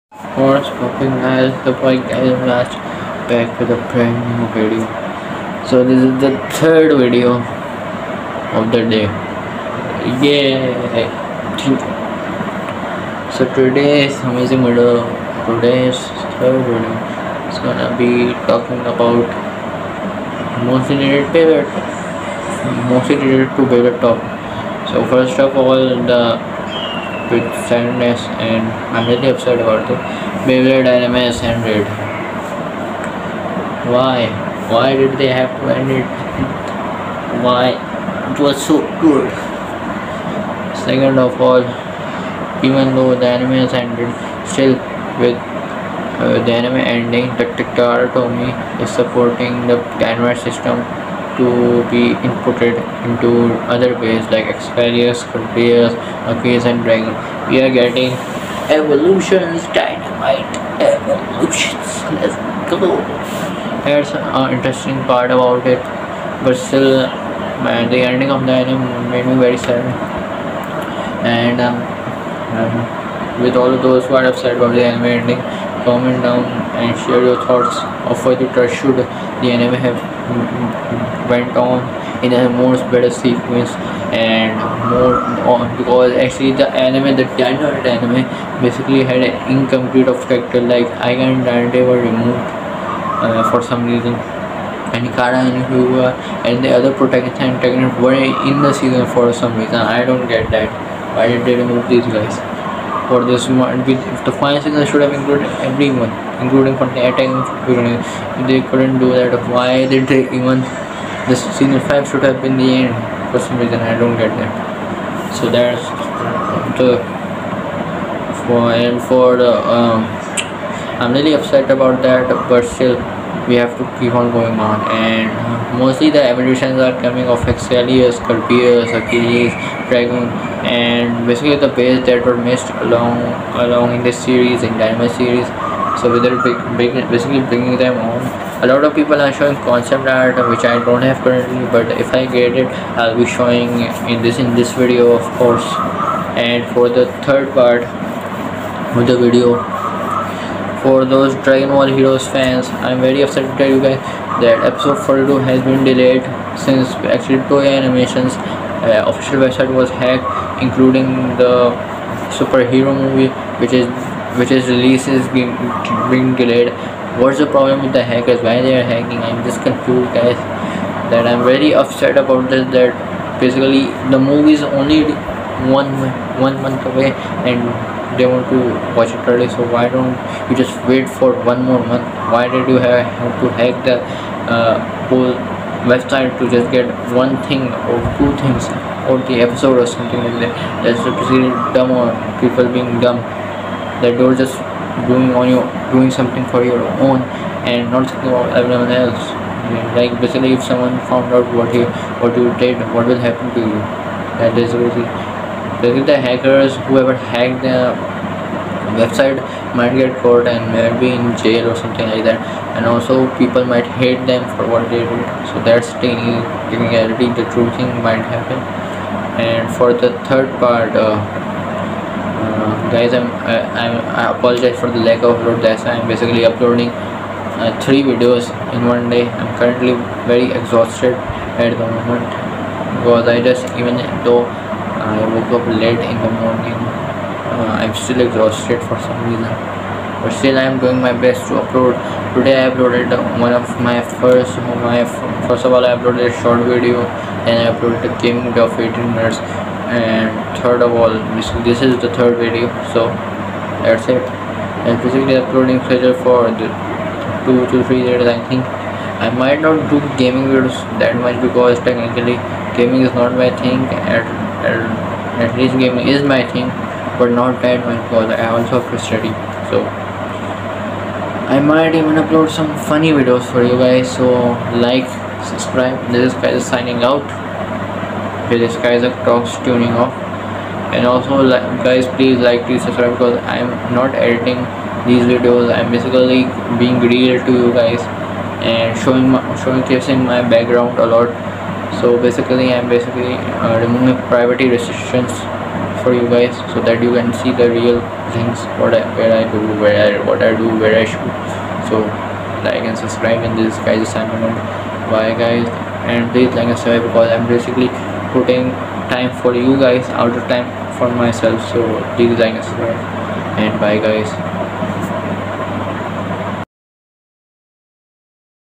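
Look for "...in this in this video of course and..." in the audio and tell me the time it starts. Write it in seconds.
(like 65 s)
144 s.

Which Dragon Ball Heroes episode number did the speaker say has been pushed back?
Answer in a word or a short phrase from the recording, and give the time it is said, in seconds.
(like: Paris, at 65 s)
42, at 154 s.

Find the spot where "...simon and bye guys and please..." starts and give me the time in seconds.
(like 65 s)
304 s.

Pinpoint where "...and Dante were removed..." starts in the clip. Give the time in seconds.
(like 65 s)
91 s.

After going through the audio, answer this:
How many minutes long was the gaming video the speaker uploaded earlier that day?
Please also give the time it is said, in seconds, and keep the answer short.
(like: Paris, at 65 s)
18, at 248 s.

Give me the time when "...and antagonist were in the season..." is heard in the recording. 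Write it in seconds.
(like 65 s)
97 s.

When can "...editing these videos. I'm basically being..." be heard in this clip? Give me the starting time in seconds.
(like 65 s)
284 s.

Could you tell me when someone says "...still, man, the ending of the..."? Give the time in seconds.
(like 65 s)
66 s.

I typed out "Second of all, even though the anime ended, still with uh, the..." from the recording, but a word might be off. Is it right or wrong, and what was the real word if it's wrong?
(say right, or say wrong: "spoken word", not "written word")
right.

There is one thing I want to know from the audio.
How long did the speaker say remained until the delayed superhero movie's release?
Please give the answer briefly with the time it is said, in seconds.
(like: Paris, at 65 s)
one month, at 175 s.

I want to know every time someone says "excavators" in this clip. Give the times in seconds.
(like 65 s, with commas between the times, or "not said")
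54 s.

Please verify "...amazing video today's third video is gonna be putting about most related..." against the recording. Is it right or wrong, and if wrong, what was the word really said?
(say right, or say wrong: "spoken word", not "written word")
wrong: "talking", not "putting".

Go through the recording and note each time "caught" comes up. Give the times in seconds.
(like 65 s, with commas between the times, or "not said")
210 s.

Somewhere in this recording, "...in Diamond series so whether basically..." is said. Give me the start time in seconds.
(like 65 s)
134 s.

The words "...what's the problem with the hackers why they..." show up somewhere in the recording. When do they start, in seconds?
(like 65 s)
167 s.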